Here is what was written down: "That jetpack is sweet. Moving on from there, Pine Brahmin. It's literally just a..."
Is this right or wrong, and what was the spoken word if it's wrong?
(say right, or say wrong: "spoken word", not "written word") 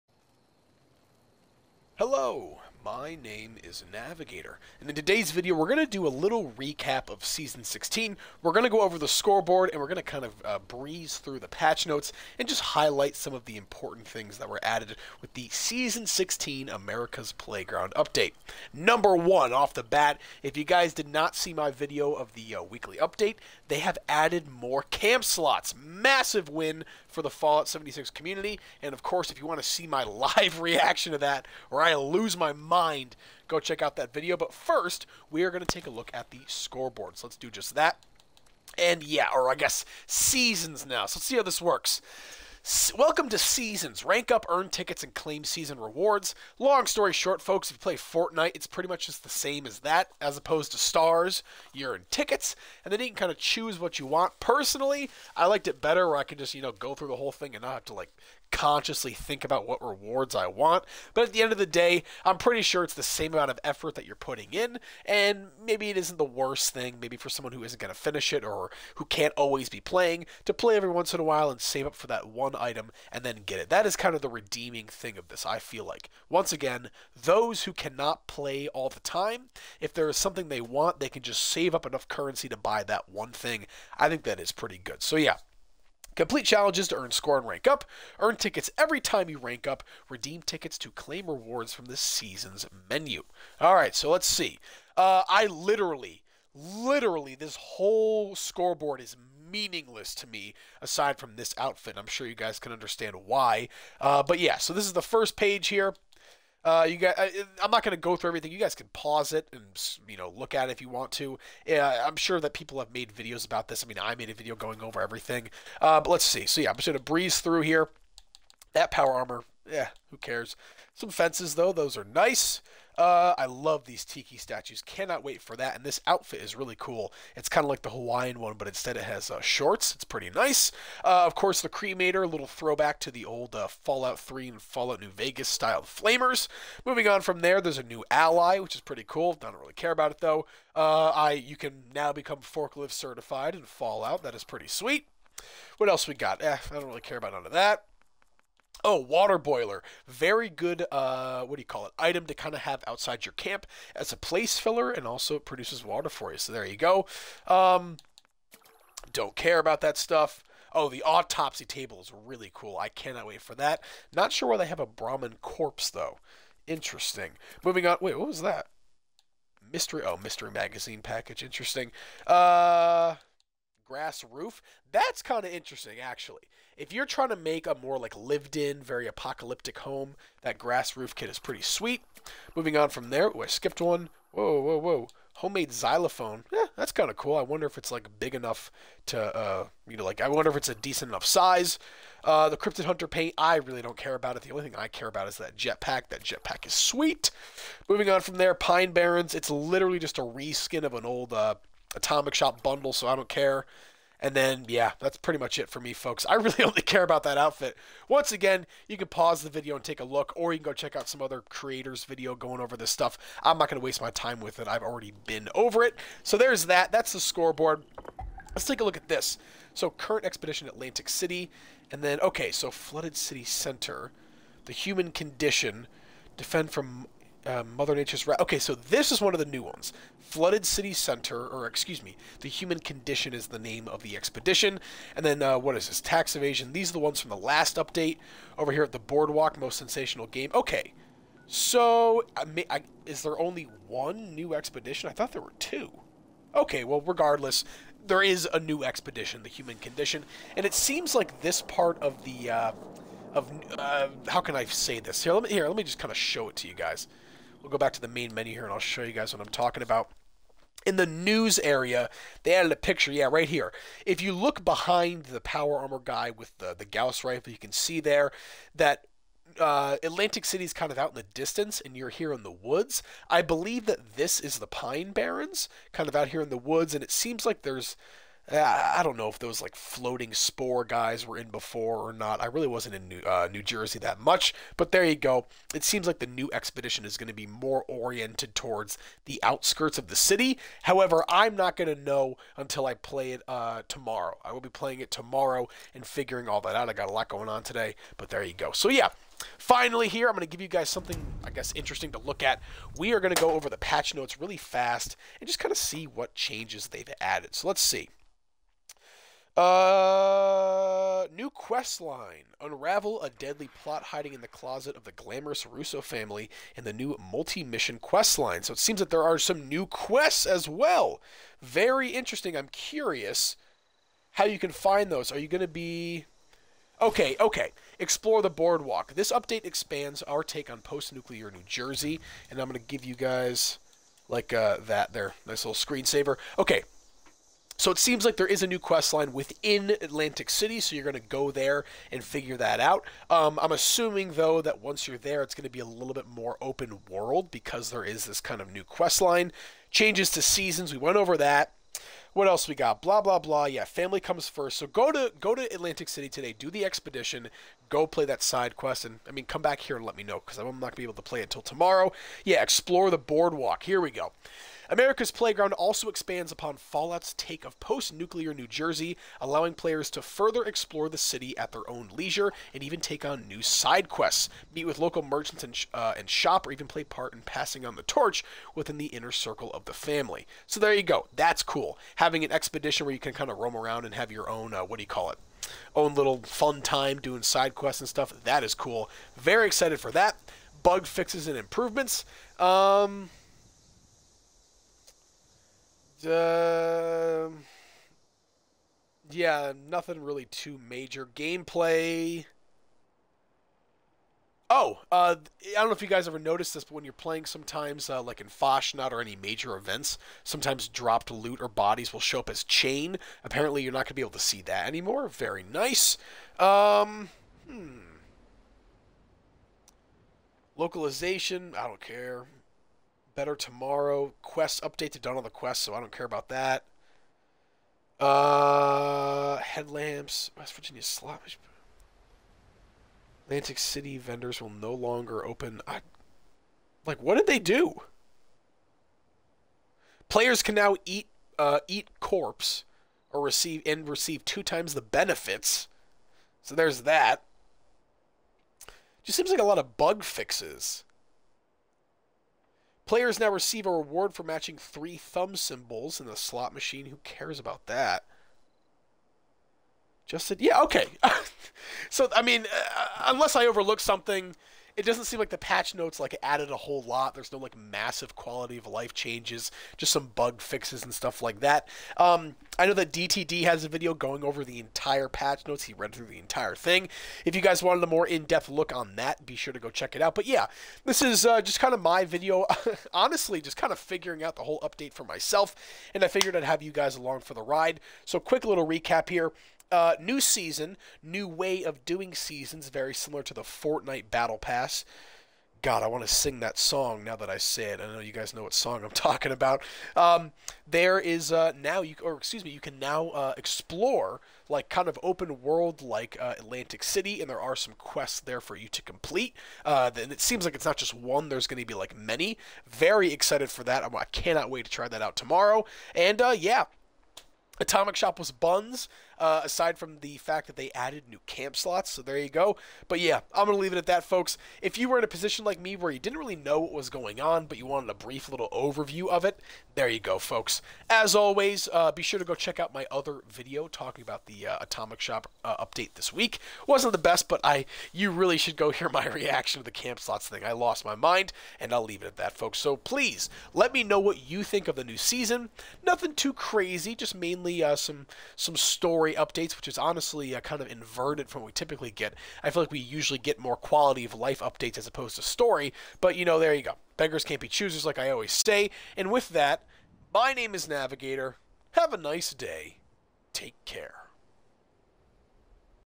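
wrong: "Barrens", not "Brahmin".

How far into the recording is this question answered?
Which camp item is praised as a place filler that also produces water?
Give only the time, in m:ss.
2:28.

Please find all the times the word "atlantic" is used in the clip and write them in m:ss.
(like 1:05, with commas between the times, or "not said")
3:40, 4:30, 5:40, 5:55, 7:13, 8:26.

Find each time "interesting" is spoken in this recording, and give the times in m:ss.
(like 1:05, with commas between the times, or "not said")
2:46, 2:51, 2:55, 5:01, 5:22.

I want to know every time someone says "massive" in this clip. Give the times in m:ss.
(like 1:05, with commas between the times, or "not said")
0:25, 7:47.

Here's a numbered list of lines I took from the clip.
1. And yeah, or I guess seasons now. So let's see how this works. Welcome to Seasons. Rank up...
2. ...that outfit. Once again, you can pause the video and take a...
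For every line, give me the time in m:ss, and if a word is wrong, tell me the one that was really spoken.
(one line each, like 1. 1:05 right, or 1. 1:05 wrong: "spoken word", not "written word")
1. 0:38 right
2. 3:27 right.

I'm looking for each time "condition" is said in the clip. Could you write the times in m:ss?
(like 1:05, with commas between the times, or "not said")
3:45, 3:52, 4:09.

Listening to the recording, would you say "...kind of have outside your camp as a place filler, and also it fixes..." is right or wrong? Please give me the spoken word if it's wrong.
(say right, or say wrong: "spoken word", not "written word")
wrong: "produces", not "fixes".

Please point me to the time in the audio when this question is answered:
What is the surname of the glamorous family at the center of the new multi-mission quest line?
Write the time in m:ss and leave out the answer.
5:15.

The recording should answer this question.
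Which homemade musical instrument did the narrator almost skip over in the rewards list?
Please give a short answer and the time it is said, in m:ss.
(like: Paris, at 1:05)
xylophone, at 3:05.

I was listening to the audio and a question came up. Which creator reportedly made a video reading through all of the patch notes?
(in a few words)
DTD.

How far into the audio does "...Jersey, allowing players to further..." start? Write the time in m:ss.
6:08.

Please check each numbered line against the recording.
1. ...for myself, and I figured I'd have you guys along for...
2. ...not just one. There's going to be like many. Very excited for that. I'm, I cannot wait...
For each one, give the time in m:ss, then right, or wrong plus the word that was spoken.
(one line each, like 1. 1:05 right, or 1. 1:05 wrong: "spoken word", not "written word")
1. 8:05 right
2. 8:30 right.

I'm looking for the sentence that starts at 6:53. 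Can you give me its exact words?
Apparently, you're not going to be able to see that anymore.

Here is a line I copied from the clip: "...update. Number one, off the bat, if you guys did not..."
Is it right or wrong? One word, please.
right.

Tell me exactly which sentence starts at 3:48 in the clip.
Okay, so this is one of the new ones.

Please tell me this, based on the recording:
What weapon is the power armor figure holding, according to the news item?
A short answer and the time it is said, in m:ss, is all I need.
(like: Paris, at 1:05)
Gauss rifle, at 4:26.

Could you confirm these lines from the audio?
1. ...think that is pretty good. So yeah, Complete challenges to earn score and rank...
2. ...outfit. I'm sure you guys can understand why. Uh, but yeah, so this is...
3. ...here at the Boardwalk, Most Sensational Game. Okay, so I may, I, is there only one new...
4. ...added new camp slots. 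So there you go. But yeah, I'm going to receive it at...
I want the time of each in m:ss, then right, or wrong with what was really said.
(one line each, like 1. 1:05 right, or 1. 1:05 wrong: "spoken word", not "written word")
1. 1:24 right
2. 1:41 right
3. 3:58 right
4. 8:40 wrong: "leave", not "receive".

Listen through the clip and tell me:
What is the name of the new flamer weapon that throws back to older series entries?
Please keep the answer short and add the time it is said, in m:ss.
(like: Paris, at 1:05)
cremator, at 2:11.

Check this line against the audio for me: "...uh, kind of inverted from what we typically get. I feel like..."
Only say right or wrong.
right.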